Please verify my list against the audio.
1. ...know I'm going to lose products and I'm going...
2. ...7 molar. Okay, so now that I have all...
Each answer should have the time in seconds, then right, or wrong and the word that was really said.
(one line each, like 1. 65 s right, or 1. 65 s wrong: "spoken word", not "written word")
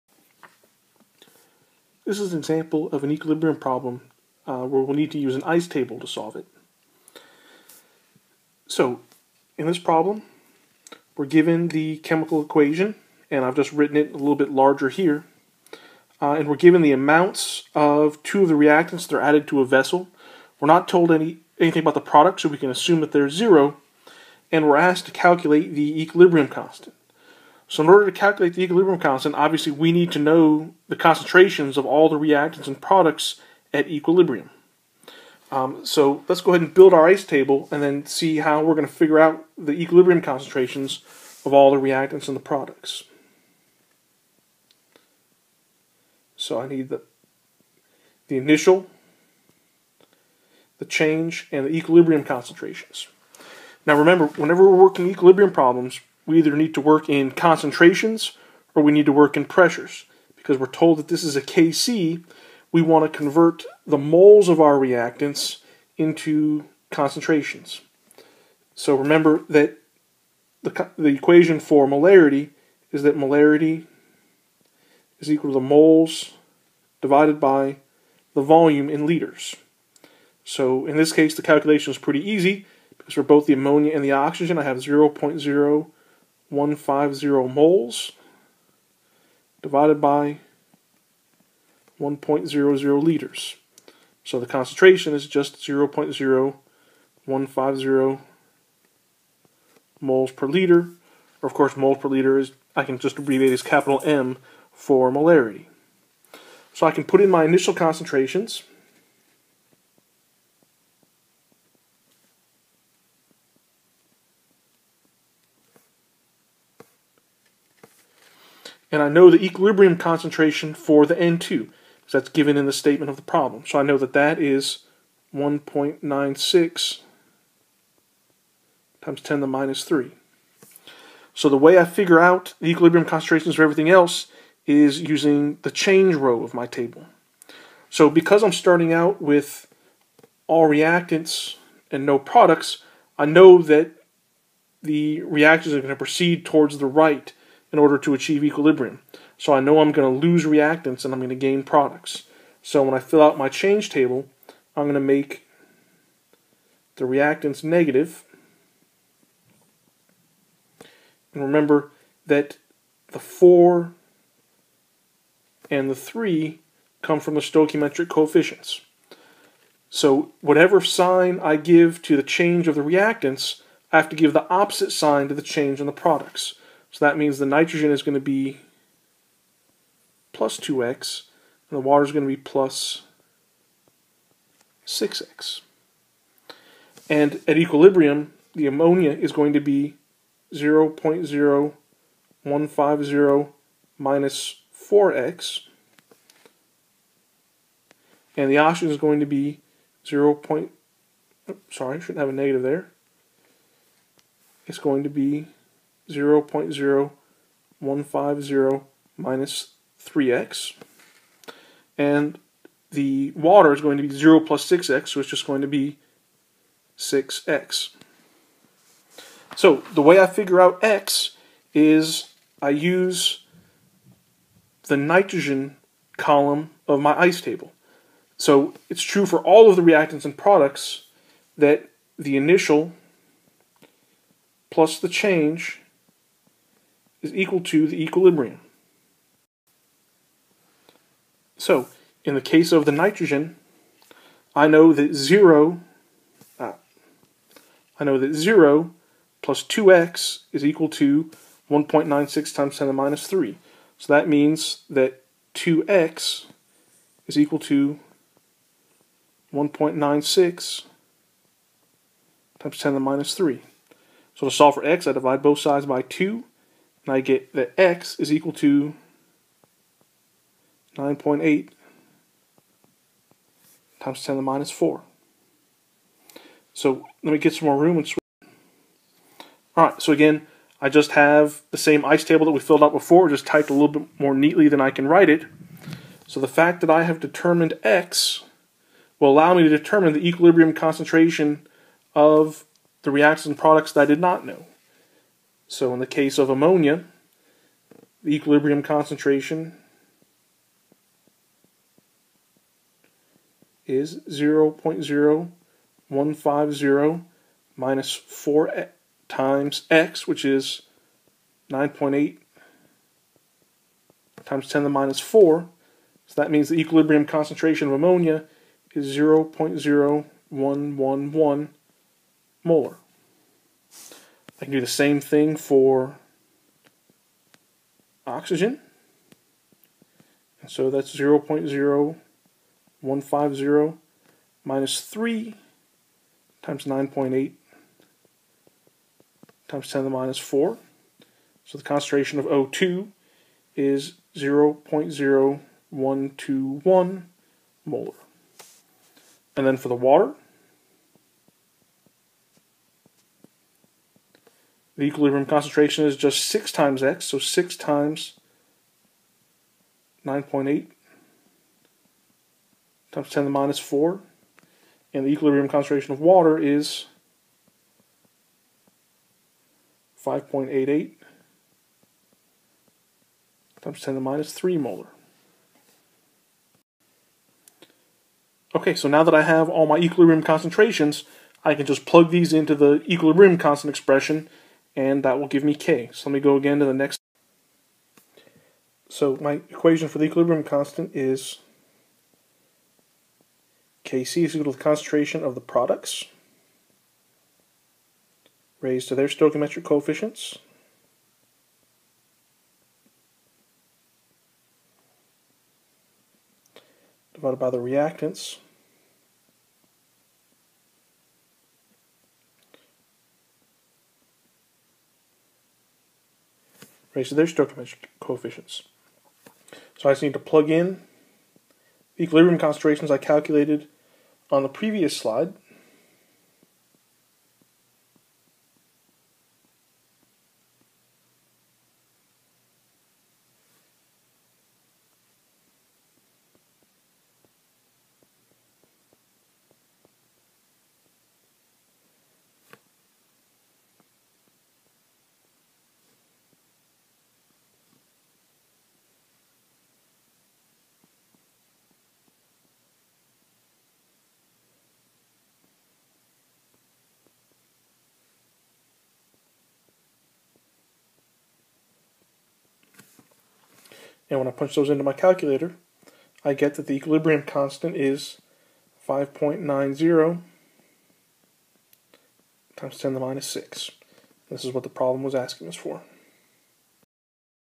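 1. 149 s wrong: "reactants", not "products"
2. 374 s wrong: "3", not "7".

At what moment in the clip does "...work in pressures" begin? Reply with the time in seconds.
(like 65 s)
59 s.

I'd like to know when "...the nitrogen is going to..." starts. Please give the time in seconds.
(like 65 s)
177 s.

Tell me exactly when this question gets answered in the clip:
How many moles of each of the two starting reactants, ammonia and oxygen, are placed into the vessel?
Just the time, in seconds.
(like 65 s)
86 s.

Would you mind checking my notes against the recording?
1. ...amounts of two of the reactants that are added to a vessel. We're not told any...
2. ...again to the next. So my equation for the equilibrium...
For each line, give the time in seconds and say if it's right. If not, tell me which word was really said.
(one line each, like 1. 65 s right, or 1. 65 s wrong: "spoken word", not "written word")
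1. 16 s right
2. 386 s right.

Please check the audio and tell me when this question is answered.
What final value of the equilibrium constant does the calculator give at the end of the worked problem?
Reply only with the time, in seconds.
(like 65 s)
469 s.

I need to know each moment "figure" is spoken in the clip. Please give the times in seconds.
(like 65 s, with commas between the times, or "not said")
38 s, 131 s, 220 s.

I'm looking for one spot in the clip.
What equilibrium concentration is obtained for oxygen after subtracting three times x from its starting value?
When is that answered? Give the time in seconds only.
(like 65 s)
344 s.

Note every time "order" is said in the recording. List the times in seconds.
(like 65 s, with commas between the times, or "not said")
27 s, 147 s.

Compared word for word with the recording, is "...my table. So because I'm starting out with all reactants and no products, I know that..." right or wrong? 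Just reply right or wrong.
right.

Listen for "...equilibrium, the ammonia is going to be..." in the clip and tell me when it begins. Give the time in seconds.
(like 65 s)
187 s.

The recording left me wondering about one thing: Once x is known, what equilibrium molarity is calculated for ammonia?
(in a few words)
0.0111 M.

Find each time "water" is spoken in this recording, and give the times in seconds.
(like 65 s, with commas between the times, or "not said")
181 s, 213 s, 349 s, 366 s.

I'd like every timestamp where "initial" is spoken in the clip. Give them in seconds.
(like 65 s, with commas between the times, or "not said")
48 s, 107 s, 232 s.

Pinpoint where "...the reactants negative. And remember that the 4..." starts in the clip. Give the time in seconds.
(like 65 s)
156 s.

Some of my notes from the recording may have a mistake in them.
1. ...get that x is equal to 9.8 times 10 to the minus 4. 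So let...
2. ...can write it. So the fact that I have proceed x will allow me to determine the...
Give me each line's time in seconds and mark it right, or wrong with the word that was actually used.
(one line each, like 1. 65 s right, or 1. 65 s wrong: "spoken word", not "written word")
1. 267 s right
2. 284 s wrong: "determined", not "proceed".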